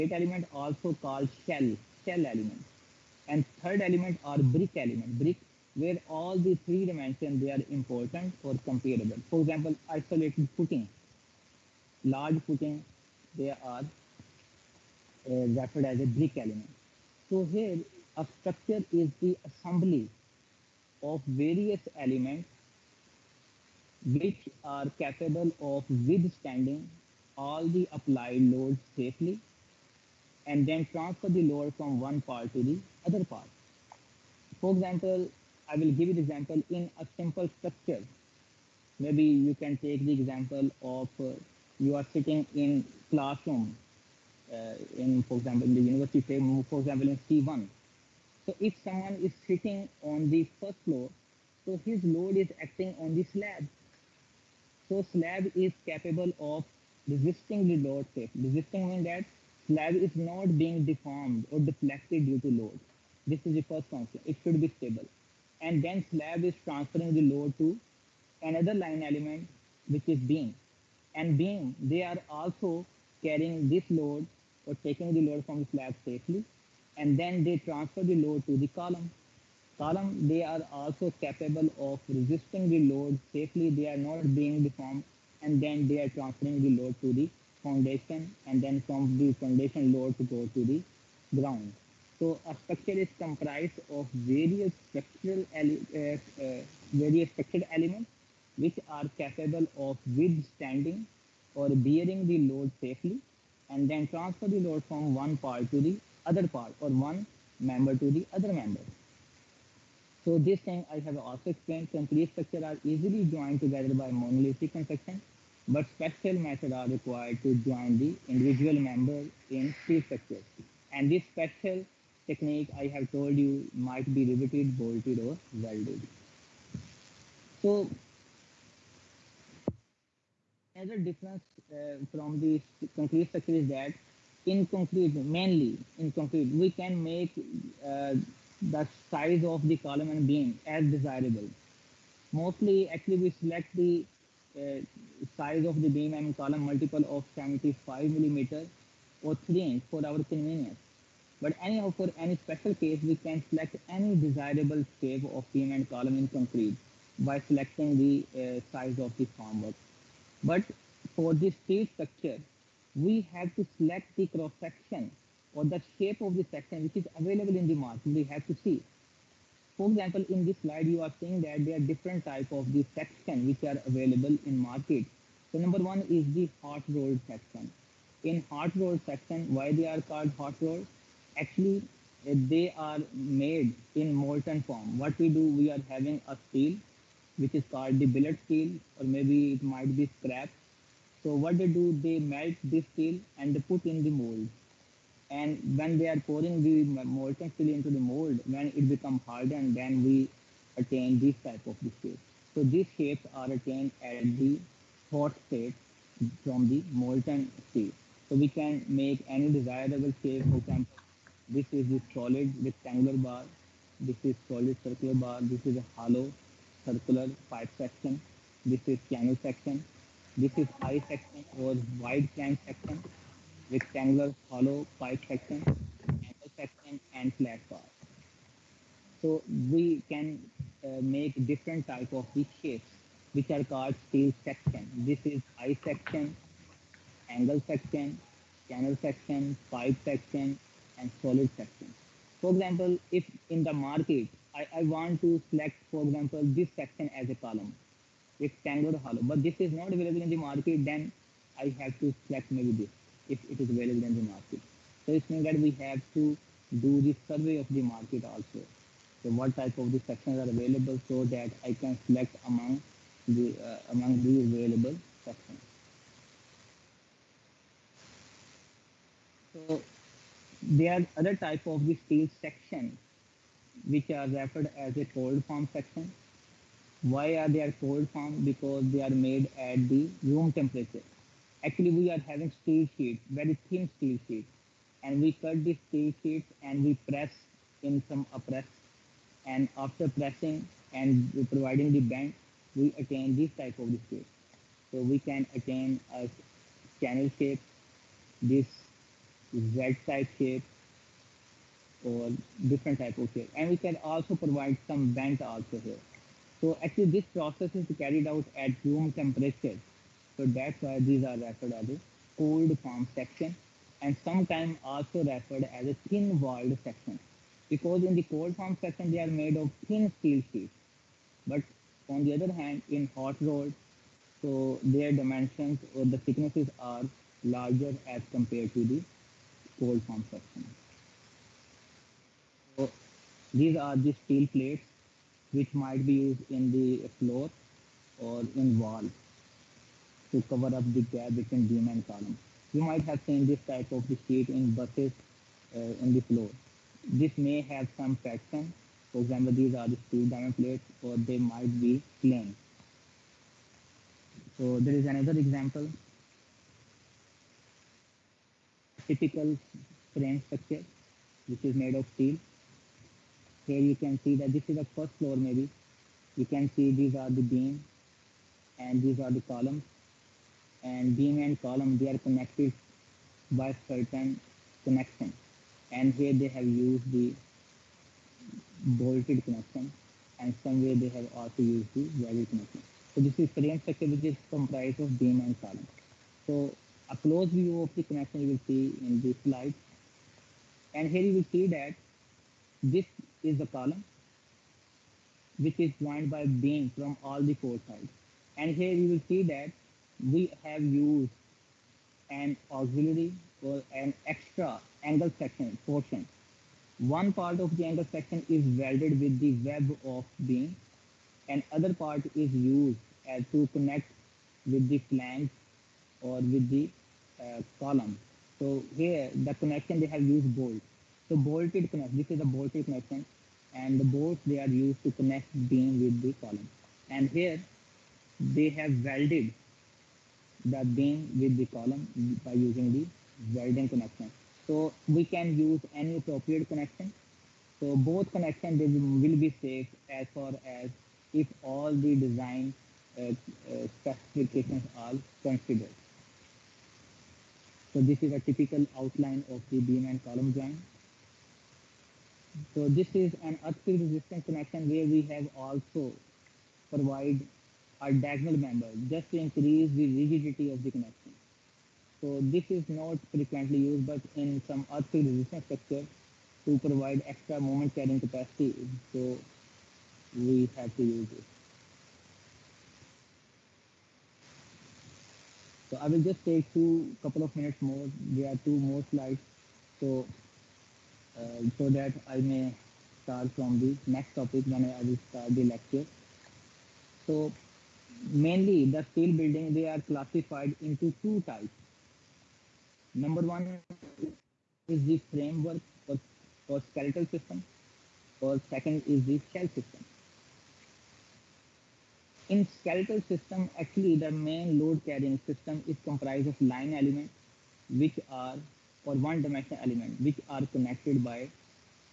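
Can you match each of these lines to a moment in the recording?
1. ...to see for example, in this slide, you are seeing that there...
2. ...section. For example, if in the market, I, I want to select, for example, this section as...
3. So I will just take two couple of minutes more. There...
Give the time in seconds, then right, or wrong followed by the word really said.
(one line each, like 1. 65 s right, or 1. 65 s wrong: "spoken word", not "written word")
1. 168 s right
2. 241 s right
3. 475 s right.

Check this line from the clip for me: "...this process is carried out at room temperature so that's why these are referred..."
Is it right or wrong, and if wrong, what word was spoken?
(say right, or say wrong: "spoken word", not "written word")
right.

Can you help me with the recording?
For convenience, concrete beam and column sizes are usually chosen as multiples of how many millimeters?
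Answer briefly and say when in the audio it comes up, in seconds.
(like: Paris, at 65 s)
75, at 147 s.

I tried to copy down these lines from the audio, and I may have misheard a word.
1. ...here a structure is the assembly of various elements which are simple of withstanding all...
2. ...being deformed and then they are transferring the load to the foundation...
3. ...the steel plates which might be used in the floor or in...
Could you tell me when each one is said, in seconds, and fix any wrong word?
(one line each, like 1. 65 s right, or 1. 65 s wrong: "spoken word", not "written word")
1. 17 s wrong: "capable", not "simple"
2. 84 s right
3. 333 s right.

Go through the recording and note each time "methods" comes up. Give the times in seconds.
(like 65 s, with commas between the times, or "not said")
116 s.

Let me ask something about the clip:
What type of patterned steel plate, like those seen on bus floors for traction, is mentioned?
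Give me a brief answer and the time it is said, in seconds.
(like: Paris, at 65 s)
diamond plates, at 350 s.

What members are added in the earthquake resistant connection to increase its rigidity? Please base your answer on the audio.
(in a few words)
diagonal members.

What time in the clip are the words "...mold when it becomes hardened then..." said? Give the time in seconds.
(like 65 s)
197 s.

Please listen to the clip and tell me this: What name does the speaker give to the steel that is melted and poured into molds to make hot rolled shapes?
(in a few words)
billet steel.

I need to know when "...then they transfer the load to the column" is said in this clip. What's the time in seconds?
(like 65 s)
77 s.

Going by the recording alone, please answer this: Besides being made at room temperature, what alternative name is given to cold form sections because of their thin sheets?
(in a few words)
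thin walled section.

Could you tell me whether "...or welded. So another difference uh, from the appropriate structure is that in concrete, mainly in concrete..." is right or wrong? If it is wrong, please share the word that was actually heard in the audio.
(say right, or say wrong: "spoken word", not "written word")
wrong: "concrete", not "appropriate".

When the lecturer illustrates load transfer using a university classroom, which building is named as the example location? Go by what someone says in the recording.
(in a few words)
C1.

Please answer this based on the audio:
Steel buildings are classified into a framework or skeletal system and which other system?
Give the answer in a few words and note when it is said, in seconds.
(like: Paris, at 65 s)
shell system, at 499 s.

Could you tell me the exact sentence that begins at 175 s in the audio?
So number one is the hot rolled section.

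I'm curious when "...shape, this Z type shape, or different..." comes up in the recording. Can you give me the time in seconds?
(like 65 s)
297 s.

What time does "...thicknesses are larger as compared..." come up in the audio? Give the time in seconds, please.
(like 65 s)
326 s.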